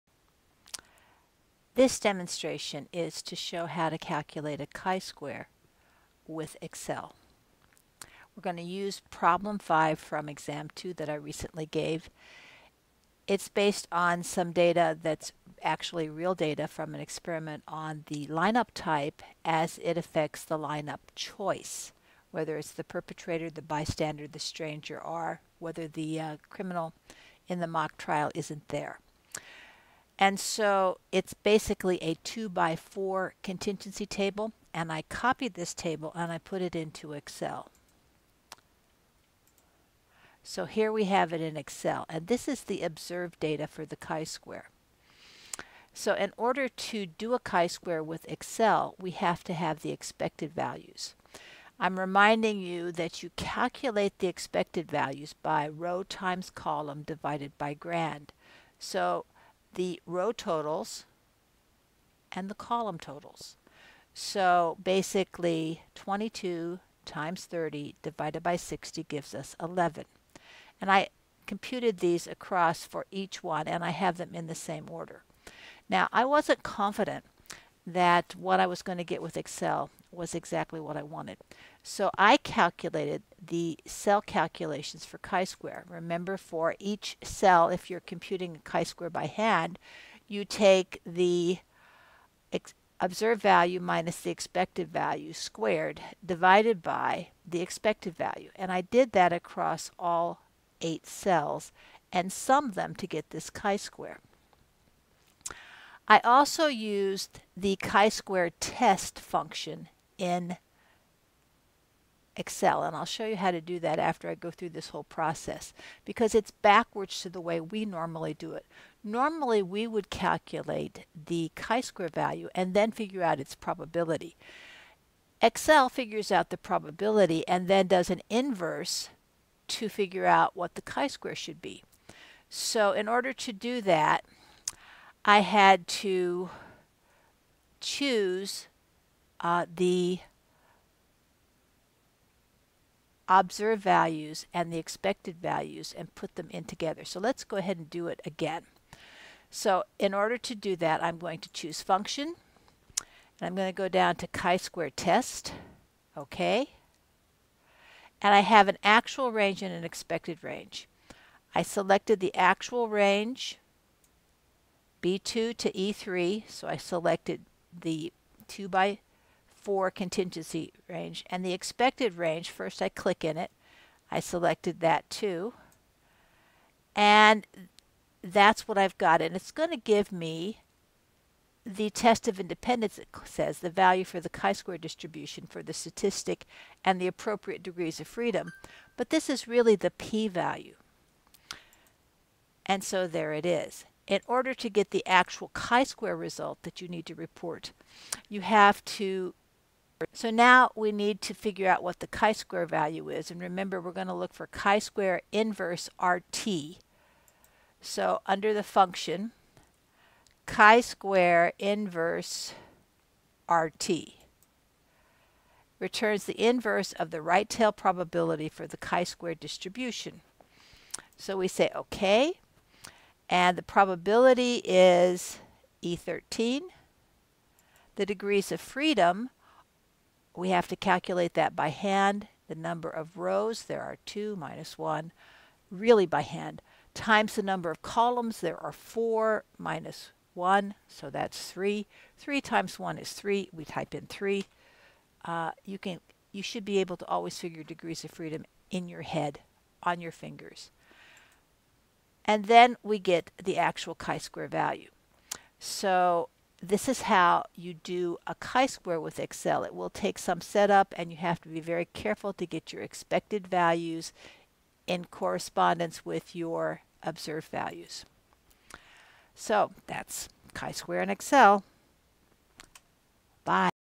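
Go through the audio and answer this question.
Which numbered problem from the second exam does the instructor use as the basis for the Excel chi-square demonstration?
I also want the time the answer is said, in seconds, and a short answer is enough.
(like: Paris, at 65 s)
5, at 9 s.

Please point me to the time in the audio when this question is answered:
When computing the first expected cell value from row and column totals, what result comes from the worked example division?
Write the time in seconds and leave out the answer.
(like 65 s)
69 s.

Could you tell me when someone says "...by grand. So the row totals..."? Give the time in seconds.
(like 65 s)
57 s.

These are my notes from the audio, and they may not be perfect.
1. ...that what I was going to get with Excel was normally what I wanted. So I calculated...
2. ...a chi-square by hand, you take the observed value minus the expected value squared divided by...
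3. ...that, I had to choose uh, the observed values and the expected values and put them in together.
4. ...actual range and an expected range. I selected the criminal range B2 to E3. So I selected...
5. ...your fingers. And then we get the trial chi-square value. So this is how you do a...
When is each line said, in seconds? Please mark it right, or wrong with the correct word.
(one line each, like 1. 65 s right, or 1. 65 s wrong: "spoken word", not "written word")
1. 77 s wrong: "exactly", not "normally"
2. 88 s right
3. 133 s right
4. 158 s wrong: "actual", not "criminal"
5. 250 s wrong: "actual", not "trial".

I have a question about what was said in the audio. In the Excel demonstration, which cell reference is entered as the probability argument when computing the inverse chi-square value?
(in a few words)
E13.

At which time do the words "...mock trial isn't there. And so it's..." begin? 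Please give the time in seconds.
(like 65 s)
27 s.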